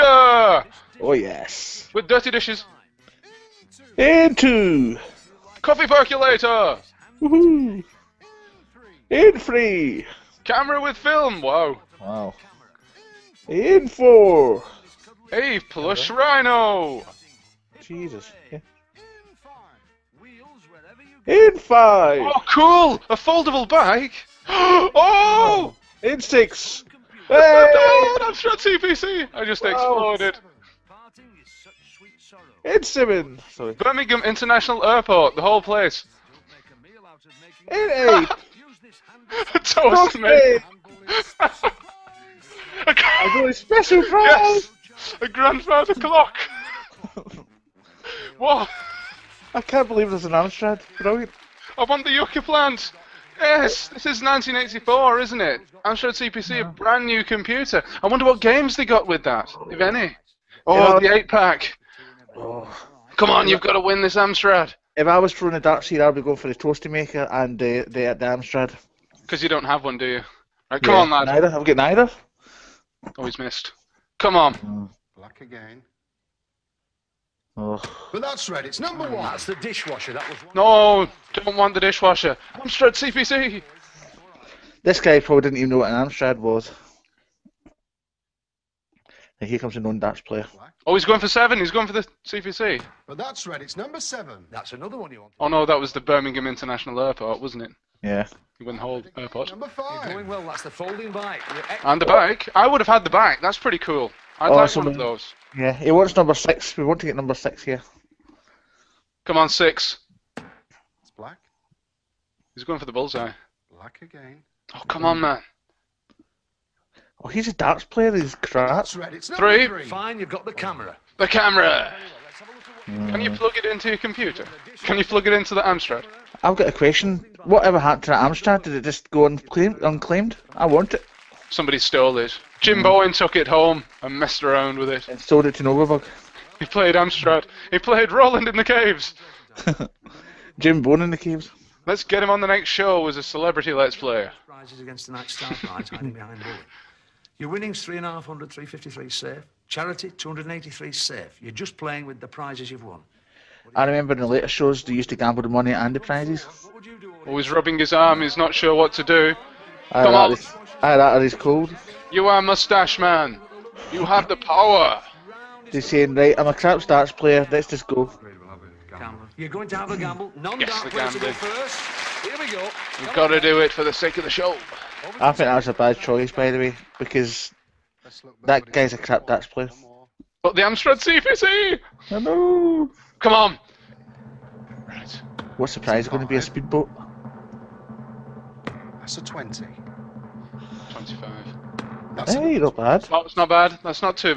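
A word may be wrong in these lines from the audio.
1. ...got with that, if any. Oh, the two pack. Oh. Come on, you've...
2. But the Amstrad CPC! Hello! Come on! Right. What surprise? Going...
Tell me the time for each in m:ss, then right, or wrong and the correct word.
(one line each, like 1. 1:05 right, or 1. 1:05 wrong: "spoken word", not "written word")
1. 0:58 wrong: "eight", not "two"
2. 3:00 right.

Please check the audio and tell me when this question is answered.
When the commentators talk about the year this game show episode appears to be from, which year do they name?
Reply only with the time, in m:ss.
0:54.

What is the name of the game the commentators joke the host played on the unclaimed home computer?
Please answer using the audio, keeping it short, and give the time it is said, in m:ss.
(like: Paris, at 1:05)
Roland in the Caves, at 2:18.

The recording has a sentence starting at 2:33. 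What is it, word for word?
I remember in the later shows they used to gamble the money and the prizes.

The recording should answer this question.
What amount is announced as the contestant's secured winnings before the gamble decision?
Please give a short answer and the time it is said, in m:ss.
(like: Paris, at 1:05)
353, at 2:29.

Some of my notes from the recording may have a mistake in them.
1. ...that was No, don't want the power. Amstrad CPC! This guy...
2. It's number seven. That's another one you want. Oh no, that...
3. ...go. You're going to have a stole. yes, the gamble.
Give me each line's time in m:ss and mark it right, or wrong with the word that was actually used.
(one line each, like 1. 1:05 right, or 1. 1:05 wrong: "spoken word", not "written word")
1. 1:20 wrong: "dishwasher", not "power"
2. 1:33 right
3. 2:47 wrong: "gamble", not "stole".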